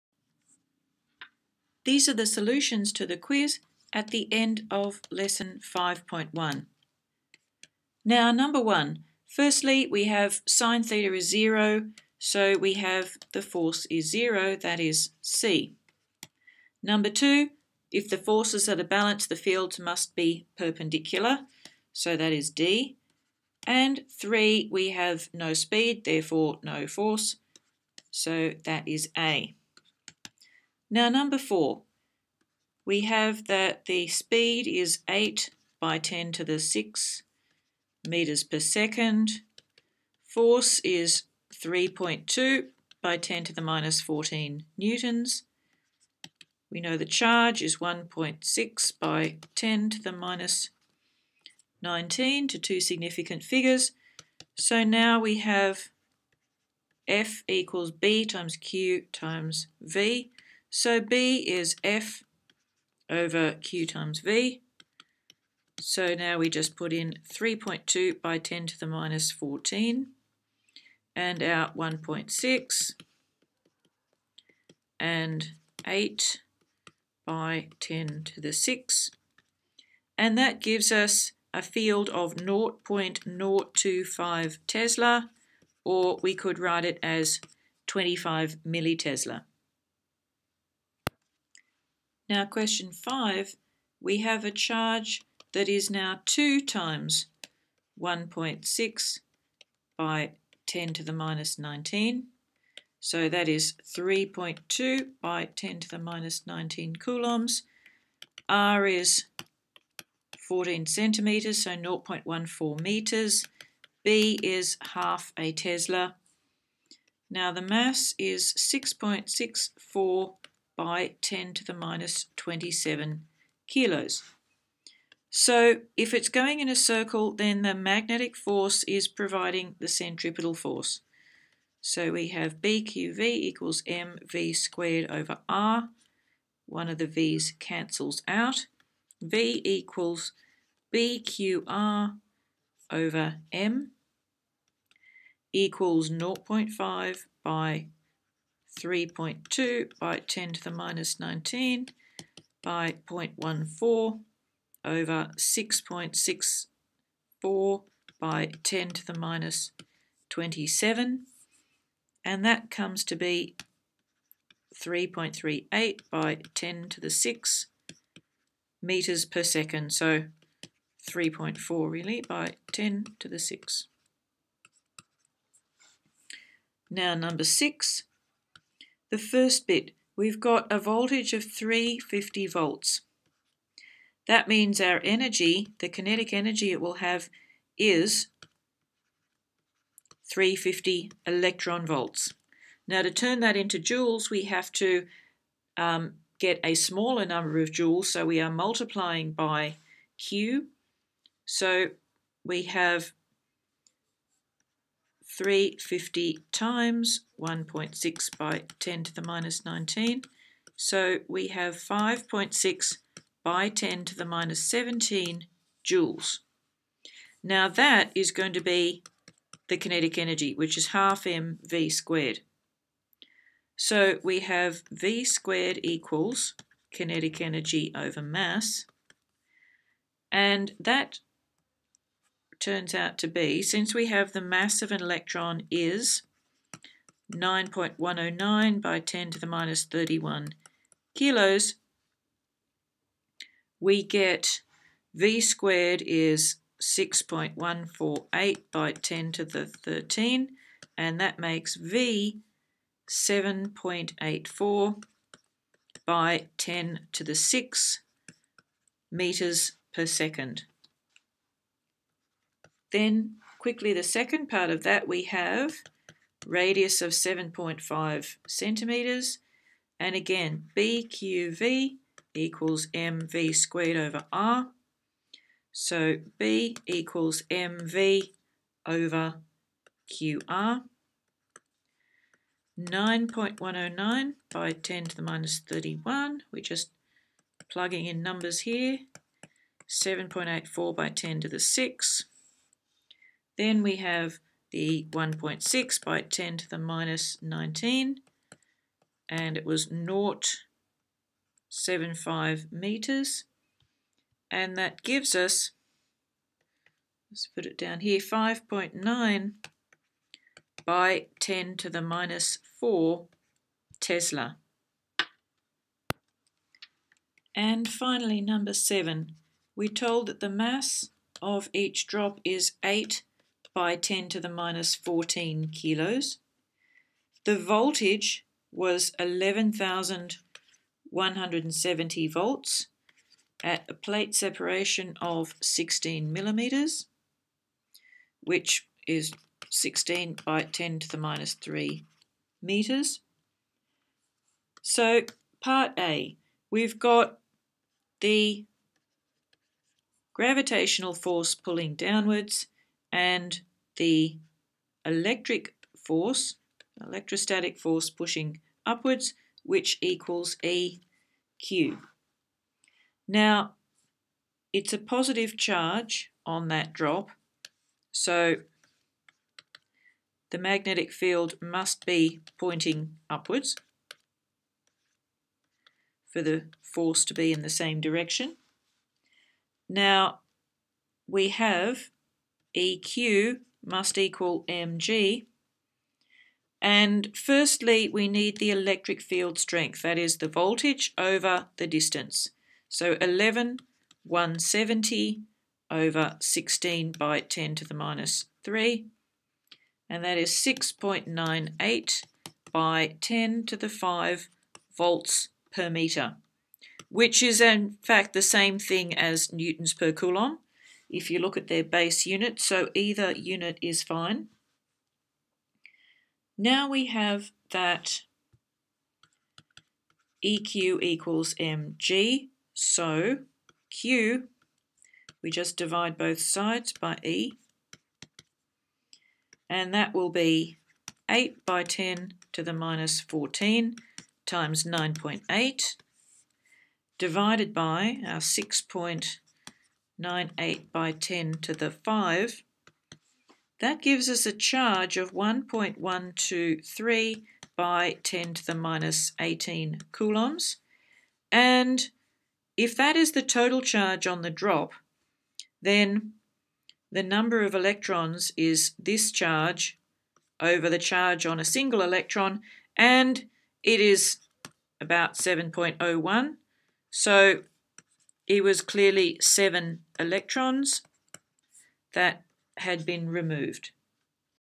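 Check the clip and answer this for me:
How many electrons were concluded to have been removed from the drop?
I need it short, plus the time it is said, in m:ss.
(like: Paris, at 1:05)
7, at 7:49.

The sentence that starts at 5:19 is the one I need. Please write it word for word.
We're told that the mass of each drop is 8 by 10 to the minus 14 kilos.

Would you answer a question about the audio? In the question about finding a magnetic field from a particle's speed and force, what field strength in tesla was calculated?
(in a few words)
0.025 Tesla.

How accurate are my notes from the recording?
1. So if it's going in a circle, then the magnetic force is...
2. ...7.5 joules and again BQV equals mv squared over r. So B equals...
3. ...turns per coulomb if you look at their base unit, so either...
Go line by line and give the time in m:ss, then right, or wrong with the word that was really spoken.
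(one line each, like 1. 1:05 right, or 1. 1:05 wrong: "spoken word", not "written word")
1. 2:05 right
2. 4:27 wrong: "centimetres", not "joules"
3. 6:49 wrong: "newtons", not "turns".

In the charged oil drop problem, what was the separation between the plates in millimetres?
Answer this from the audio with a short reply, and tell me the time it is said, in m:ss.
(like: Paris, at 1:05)
16 millimeters, at 5:35.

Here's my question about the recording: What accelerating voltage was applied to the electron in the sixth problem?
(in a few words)
350 volts.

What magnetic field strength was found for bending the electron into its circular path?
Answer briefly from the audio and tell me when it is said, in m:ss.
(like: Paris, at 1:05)
5.9 x 10^-4 Tesla, at 5:08.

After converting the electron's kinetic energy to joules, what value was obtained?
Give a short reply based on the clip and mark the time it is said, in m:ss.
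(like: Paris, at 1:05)
5.6 x 10^-17 joules, at 3:31.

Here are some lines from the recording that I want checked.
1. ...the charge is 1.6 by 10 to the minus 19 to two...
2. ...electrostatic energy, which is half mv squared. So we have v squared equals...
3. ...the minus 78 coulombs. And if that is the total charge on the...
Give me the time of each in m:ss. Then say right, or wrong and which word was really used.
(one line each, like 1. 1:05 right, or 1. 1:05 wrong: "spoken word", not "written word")
1. 0:46 right
2. 3:39 wrong: "kinetic", not "electrostatic"
3. 7:28 wrong: "18", not "78".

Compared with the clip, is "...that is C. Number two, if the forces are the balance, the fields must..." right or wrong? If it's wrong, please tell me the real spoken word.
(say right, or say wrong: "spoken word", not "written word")
right.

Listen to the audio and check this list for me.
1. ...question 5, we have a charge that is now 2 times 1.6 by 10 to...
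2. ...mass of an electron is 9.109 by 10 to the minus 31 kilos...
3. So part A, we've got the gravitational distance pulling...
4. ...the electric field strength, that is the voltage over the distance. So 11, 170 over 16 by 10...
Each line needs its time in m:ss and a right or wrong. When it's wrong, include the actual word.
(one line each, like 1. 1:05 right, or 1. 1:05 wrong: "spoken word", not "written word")
1. 1:32 right
2. 3:54 right
3. 5:44 wrong: "force", not "distance"
4. 6:28 right.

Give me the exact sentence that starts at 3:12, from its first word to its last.
Now to turn that into joules, we have to um, get a smaller number of joules, so we are multiplying by Q.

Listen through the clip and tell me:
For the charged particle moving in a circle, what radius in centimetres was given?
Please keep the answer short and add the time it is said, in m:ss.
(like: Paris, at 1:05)
14 centimetres, at 1:50.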